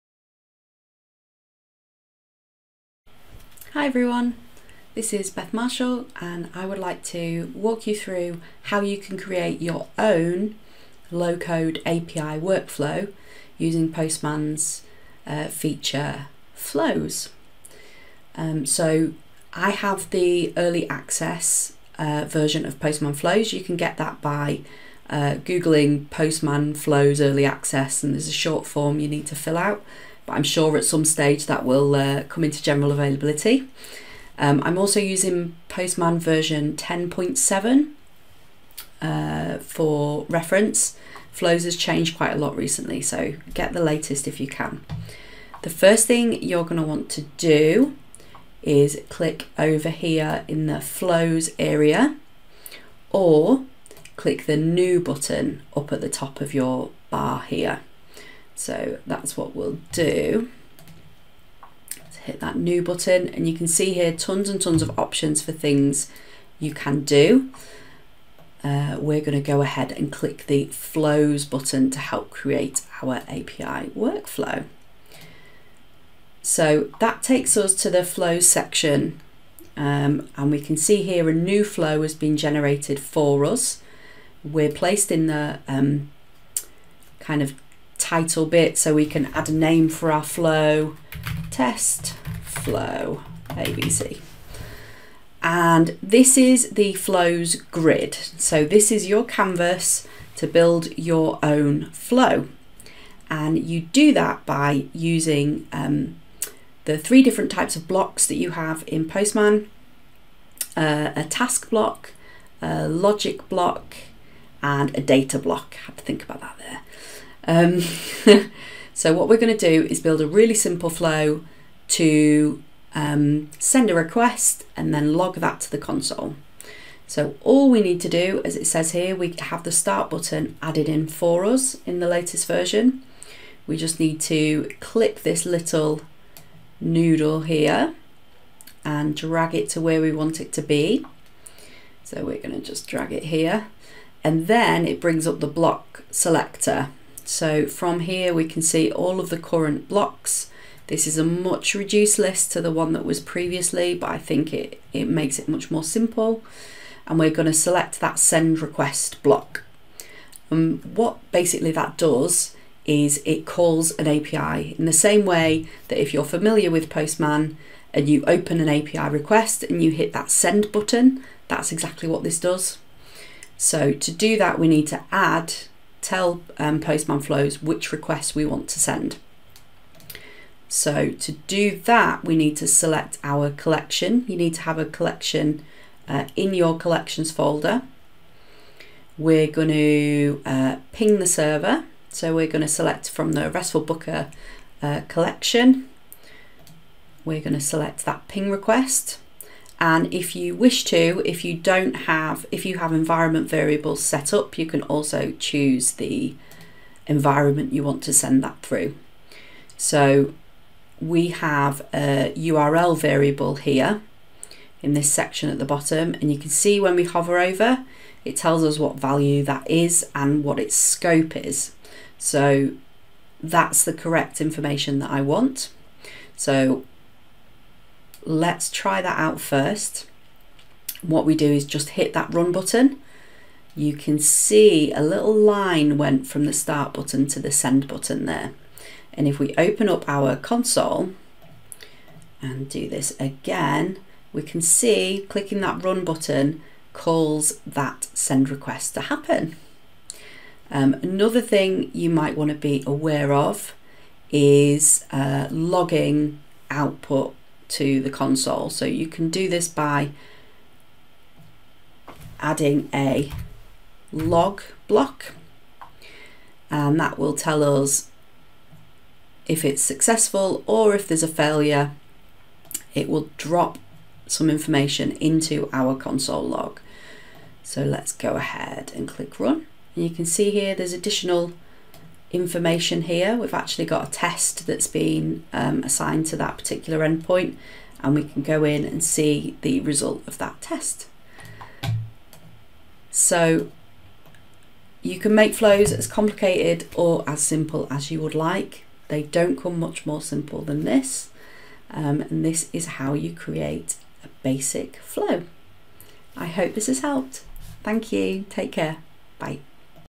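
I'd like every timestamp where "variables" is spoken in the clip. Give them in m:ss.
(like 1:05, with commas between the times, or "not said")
3:23, 3:32.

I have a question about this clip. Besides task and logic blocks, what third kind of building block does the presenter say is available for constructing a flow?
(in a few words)
Data block.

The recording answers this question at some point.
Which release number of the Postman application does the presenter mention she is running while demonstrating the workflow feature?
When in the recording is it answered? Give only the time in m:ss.
0:36.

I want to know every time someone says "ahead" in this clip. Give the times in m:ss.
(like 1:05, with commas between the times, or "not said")
1:09, 4:38.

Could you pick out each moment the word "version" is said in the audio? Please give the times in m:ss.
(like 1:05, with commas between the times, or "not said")
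0:22, 0:36, 2:12.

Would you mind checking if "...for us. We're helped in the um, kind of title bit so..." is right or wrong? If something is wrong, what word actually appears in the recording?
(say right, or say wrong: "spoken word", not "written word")
wrong: "placed", not "helped".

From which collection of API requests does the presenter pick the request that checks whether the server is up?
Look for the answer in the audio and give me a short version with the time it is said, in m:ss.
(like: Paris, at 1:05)
RESTful Booker, at 3:13.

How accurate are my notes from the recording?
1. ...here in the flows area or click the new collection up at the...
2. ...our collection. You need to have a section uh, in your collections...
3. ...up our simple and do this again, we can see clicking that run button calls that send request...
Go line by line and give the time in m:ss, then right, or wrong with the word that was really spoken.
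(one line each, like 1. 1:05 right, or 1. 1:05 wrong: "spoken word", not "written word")
1. 0:49 wrong: "button", not "collection"
2. 3:03 wrong: "collection", not "section"
3. 3:59 wrong: "console", not "simple".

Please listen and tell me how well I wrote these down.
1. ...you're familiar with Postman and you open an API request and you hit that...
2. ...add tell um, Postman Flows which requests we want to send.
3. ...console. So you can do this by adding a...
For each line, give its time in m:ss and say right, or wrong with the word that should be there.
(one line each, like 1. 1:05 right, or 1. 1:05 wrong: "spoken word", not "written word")
1. 2:46 right
2. 2:55 right
3. 4:18 right.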